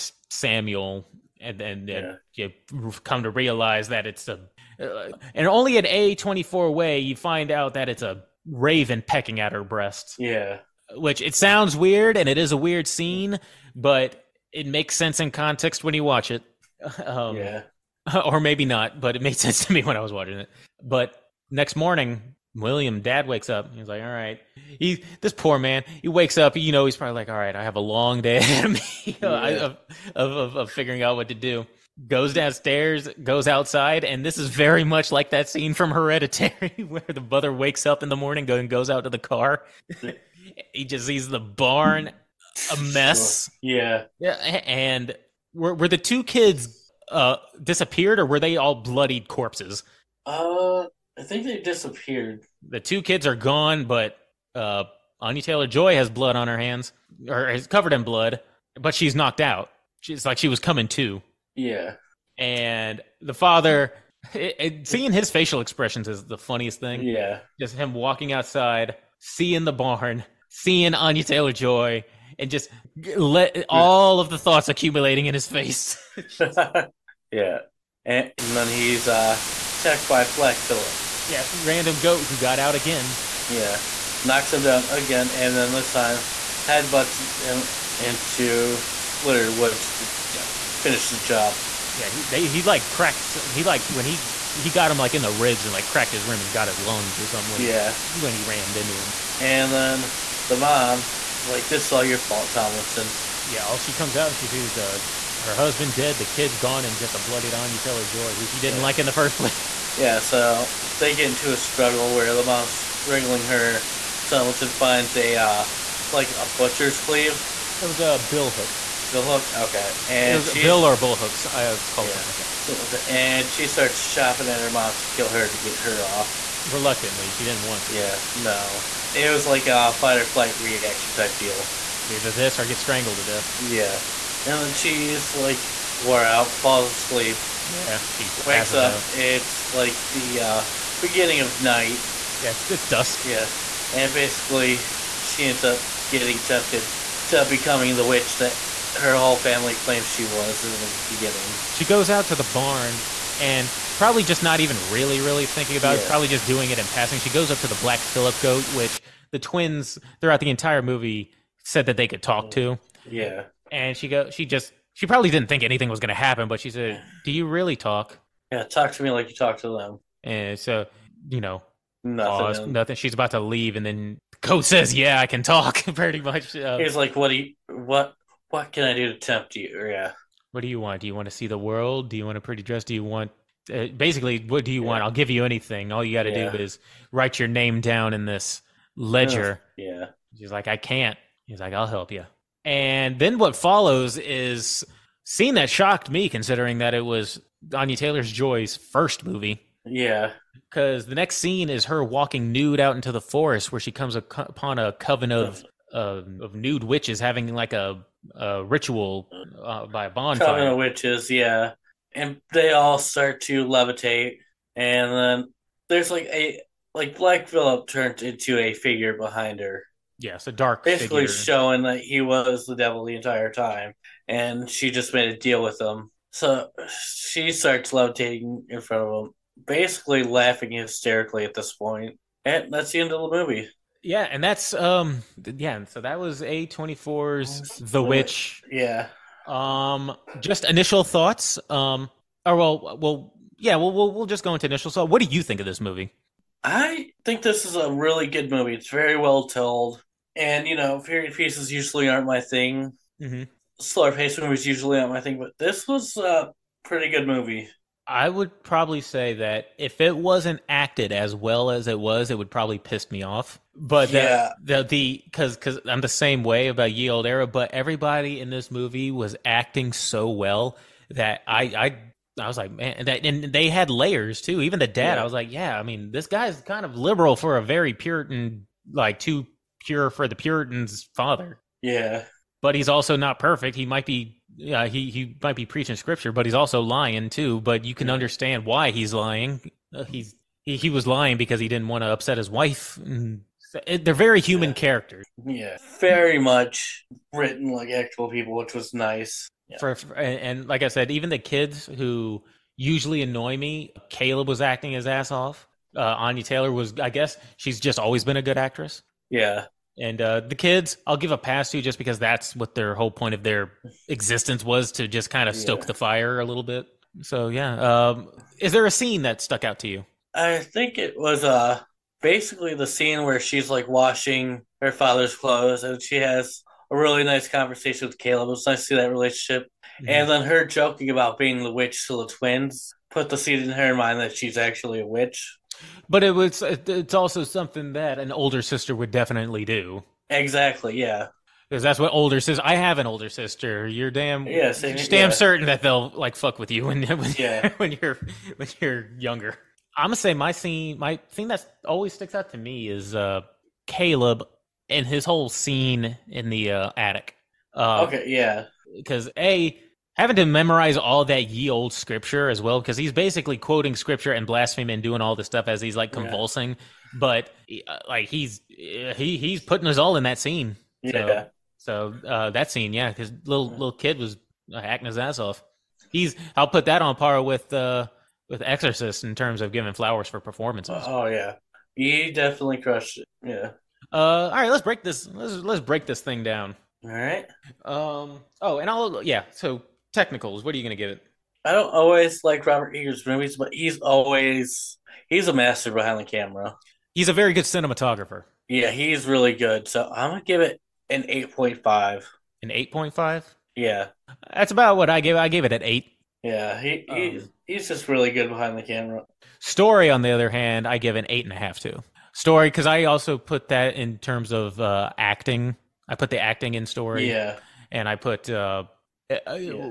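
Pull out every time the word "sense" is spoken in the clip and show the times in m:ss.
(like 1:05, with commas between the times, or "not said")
0:14, 0:19.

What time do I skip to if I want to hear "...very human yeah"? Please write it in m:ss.
4:54.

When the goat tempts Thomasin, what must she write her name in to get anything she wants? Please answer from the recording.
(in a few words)
Ledger.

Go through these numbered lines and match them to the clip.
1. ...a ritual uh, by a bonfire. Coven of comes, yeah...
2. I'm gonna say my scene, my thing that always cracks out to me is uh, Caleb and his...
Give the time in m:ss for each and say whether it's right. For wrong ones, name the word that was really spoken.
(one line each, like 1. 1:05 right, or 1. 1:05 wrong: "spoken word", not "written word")
1. 3:28 wrong: "witches", not "comes"
2. 5:49 wrong: "sticks", not "cracks".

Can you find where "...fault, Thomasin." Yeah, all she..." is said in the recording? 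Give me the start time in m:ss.
1:42.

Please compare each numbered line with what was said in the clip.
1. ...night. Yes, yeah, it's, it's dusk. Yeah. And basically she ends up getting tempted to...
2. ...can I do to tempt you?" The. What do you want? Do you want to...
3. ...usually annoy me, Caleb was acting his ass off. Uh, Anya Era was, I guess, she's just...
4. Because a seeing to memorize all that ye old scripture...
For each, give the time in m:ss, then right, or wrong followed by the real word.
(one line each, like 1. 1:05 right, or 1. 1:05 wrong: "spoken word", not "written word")
1. 2:21 right
2. 2:58 wrong: "Yeah", not "The"
3. 5:02 wrong: "Taylor", not "Era"
4. 5:58 wrong: "having", not "seeing".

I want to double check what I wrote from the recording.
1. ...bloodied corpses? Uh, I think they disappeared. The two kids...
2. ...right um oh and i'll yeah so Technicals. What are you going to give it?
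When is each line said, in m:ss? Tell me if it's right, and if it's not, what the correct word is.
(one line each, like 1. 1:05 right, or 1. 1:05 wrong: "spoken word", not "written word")
1. 0:48 right
2. 6:27 right.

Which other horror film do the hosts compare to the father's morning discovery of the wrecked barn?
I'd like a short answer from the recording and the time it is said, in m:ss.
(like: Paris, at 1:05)
Hereditary, at 0:35.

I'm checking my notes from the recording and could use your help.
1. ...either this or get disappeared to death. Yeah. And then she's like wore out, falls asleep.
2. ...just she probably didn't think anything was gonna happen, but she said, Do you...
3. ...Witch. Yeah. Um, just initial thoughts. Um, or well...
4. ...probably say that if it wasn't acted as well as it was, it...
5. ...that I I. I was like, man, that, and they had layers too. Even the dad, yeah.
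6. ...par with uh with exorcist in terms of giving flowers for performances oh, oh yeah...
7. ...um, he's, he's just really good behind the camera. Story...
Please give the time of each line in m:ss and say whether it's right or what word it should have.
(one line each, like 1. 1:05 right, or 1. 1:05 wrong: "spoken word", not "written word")
1. 2:12 wrong: "strangled", not "disappeared"
2. 2:44 right
3. 3:58 right
4. 4:18 right
5. 4:31 right
6. 6:17 right
7. 6:47 right.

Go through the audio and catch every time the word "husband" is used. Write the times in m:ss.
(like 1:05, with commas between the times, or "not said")
1:45.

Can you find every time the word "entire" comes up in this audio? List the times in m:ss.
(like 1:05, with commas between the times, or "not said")
2:40, 3:43.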